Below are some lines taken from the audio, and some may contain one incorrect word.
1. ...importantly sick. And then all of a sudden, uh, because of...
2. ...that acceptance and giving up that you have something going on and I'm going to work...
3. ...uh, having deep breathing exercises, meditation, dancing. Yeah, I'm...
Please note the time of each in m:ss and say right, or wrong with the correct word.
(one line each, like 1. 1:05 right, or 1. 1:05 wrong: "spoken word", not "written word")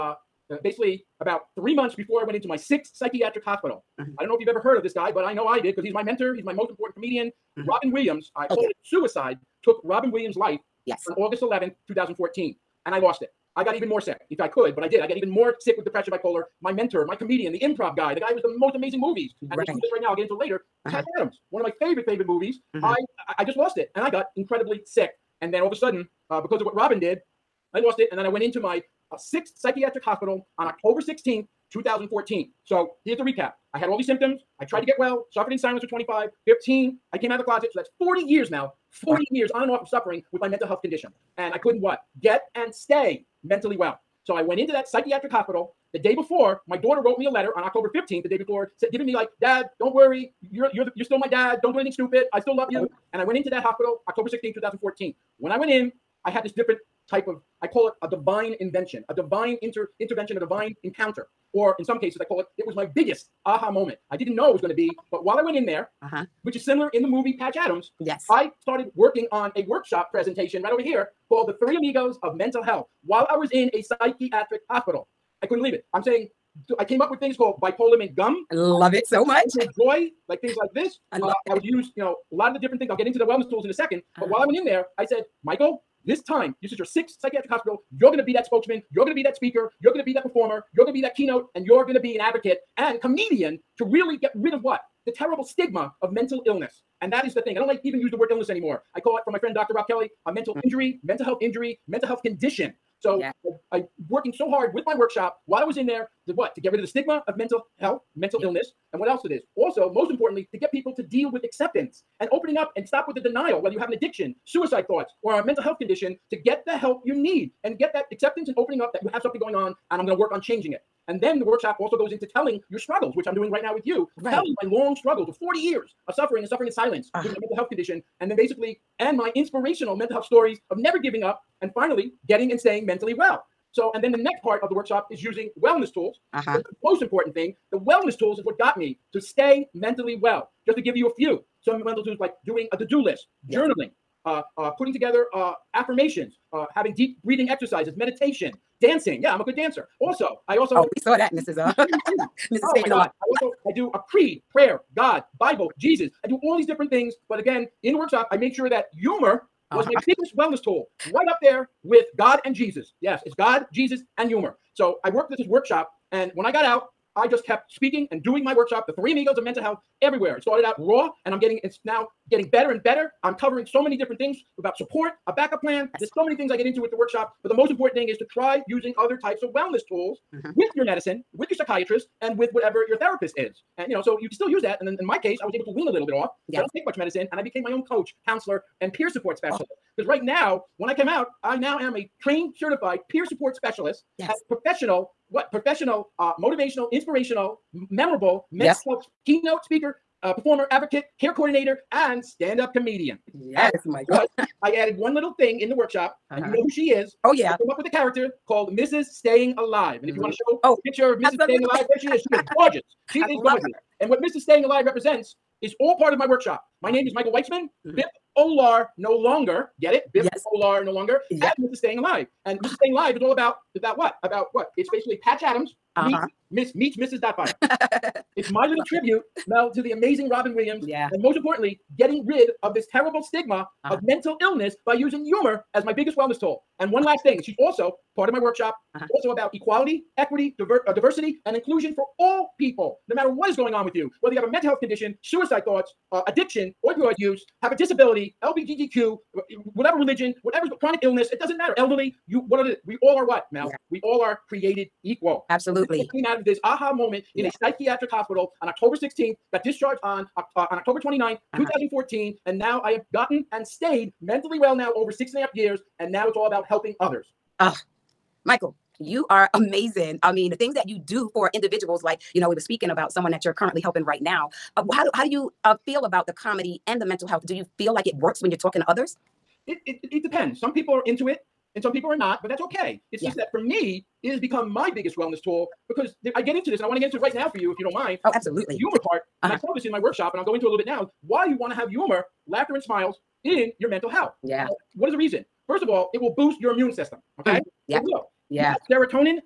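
1. 0:24 wrong: "incredibly", not "importantly"
2. 1:57 wrong: "opening", not "giving"
3. 2:26 right.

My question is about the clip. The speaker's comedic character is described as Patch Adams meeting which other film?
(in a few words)
Mrs. Doubtfire.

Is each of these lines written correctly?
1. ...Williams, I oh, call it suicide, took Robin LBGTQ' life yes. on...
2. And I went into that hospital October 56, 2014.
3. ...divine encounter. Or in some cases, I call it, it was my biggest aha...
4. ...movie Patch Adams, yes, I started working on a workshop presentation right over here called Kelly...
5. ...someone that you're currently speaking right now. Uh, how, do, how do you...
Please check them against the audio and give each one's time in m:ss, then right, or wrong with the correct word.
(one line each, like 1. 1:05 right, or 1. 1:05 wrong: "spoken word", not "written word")
1. 0:07 wrong: "Williams", not "LBGTQ"
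2. 0:53 wrong: "16", not "56"
3. 1:00 right
4. 1:07 wrong: "The", not "Kelly"
5. 4:33 wrong: "helping", not "speaking".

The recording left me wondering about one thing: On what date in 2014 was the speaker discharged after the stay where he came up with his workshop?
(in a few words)
October 29.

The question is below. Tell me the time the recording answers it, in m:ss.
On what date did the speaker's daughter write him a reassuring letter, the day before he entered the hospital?
0:47.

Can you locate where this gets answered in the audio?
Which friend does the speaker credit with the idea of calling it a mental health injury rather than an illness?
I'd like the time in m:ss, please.
1:39.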